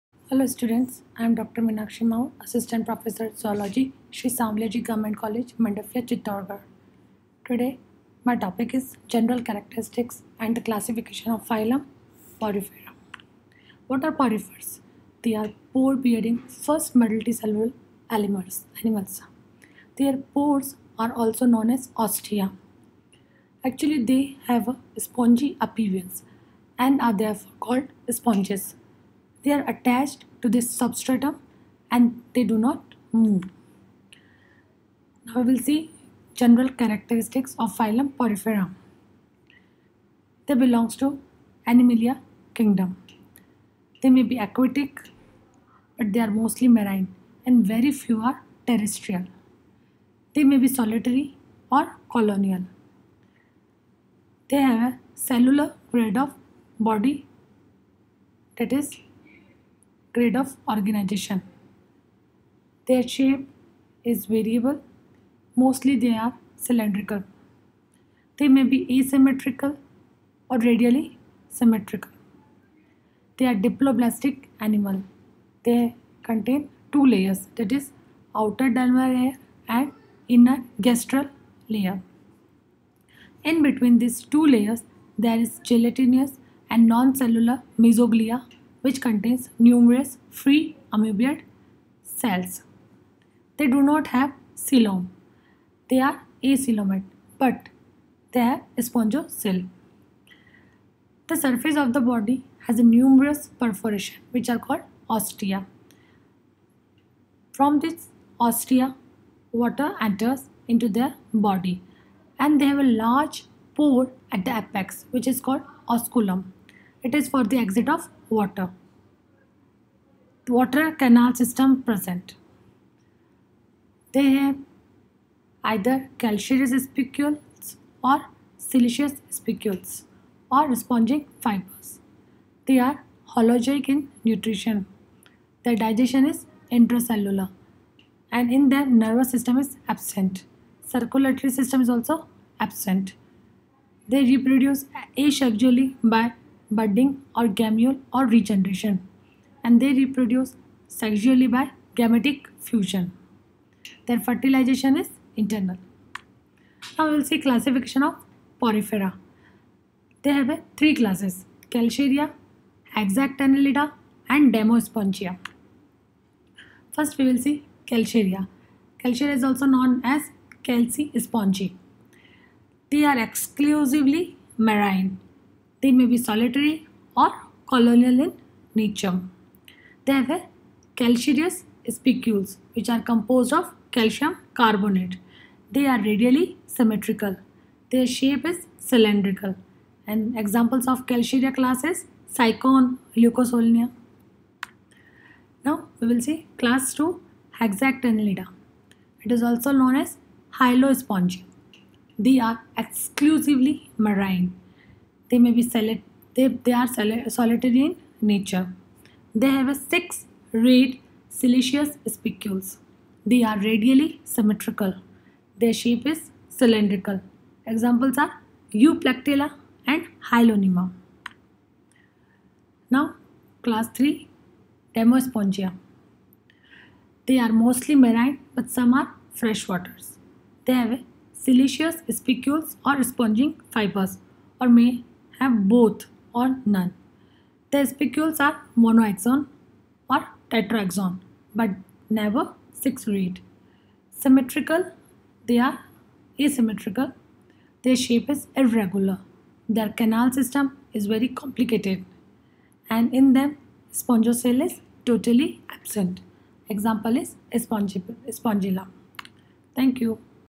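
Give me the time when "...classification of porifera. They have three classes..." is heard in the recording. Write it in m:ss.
2:37.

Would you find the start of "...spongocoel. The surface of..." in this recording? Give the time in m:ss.
1:38.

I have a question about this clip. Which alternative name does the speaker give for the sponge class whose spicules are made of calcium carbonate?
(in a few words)
calci spongy.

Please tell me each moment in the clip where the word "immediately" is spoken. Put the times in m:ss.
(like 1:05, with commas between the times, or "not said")
not said.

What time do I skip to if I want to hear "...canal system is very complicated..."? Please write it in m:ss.
4:10.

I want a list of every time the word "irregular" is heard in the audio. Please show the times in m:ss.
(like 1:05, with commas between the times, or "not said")
4:08.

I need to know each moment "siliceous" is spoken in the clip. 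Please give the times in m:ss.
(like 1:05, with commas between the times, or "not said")
2:08, 3:31, 3:51.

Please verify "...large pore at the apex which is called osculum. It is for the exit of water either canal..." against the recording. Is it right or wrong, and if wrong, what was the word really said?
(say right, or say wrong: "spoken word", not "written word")
wrong: "water", not "either".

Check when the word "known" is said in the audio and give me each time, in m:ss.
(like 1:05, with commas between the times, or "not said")
0:21, 2:49, 3:19.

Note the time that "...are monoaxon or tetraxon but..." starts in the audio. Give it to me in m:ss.
3:58.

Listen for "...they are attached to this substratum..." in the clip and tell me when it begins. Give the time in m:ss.
0:29.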